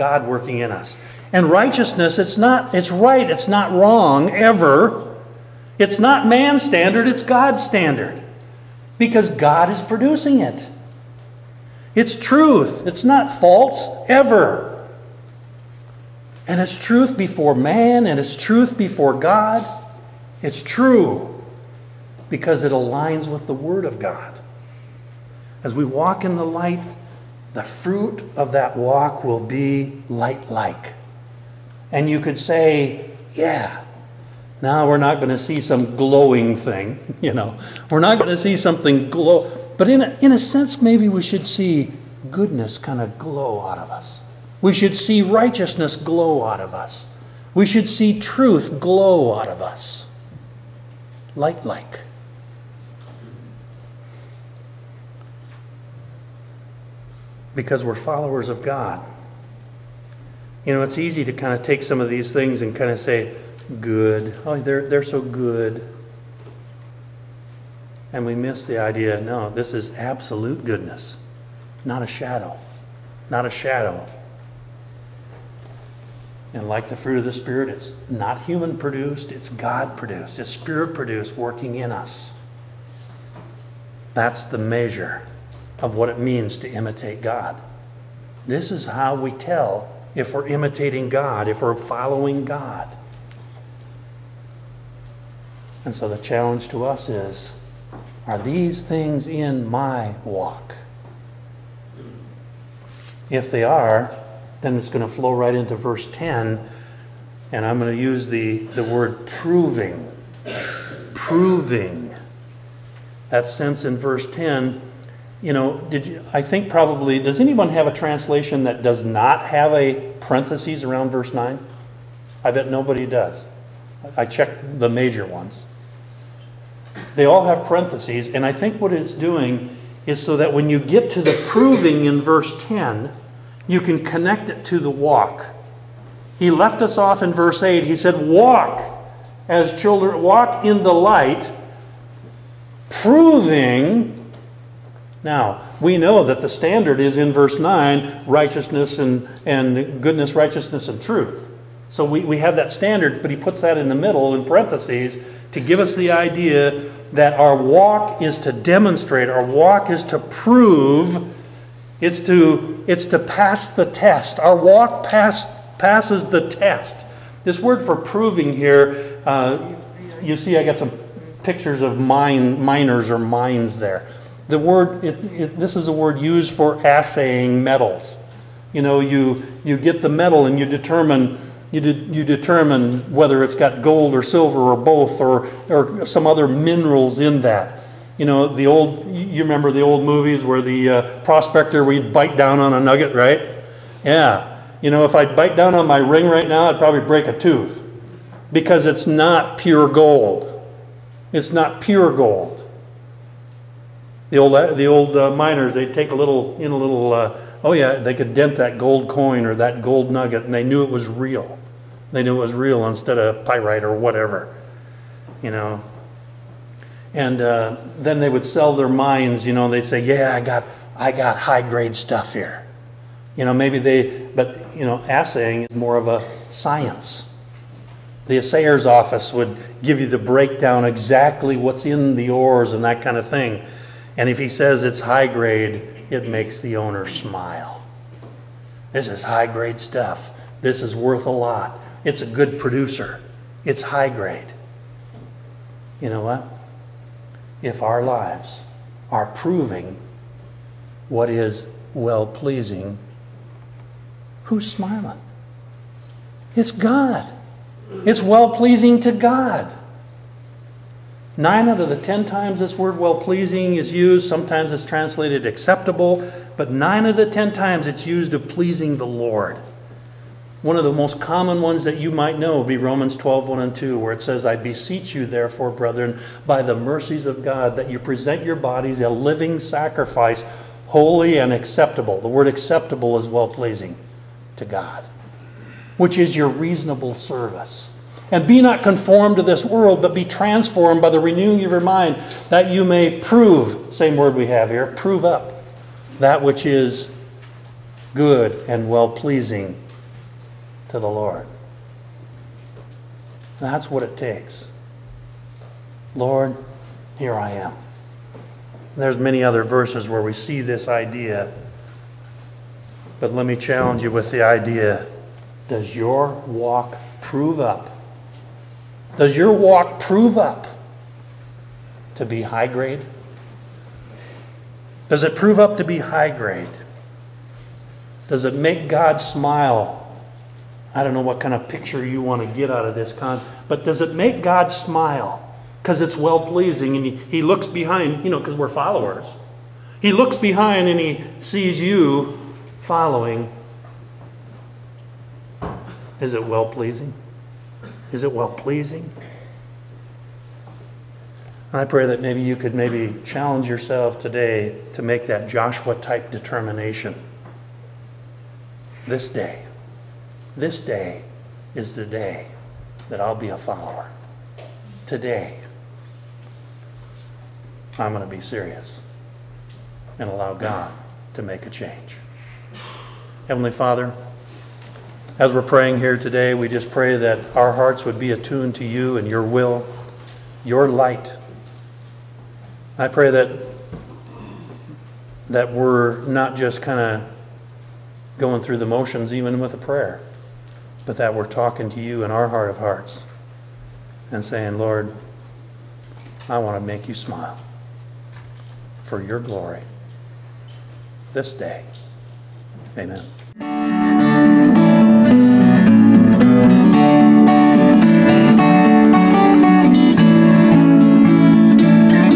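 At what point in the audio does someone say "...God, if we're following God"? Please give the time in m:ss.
1:31.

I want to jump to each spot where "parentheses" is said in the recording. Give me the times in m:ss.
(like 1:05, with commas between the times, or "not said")
2:00, 2:07, 2:34.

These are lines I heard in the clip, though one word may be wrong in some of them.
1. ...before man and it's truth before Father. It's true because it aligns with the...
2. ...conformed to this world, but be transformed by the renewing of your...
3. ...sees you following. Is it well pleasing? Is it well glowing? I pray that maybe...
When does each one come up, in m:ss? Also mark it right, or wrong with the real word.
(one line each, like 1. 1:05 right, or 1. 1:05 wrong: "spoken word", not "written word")
1. 0:17 wrong: "God", not "Father"
2. 4:48 right
3. 5:41 wrong: "pleasing", not "glowing".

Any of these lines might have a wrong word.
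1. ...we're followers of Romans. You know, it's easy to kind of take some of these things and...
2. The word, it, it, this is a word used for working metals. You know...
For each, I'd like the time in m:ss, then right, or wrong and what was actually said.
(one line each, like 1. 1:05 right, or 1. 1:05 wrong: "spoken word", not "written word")
1. 0:57 wrong: "God", not "Romans"
2. 2:54 wrong: "assaying", not "working".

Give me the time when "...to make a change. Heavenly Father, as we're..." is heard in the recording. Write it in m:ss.
6:11.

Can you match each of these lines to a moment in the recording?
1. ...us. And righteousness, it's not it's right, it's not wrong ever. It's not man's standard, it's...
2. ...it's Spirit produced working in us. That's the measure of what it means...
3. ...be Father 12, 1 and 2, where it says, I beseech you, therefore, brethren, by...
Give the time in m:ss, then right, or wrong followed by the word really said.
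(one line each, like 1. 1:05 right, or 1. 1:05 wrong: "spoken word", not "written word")
1. 0:00 right
2. 1:20 right
3. 4:32 wrong: "Romans", not "Father".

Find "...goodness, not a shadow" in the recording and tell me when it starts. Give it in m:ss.
1:10.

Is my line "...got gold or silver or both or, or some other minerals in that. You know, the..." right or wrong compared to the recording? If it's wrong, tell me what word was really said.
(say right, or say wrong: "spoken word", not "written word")
right.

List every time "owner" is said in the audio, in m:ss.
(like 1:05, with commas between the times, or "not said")
3:56.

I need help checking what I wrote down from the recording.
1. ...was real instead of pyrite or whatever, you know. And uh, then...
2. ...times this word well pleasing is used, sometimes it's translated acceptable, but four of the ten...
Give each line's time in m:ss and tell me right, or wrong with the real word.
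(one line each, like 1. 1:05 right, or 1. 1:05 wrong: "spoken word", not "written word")
1. 3:32 right
2. 4:22 wrong: "nine", not "four".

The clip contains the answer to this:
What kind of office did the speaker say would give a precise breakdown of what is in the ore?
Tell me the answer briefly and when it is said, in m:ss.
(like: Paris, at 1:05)
Assayer's office, at 3:48.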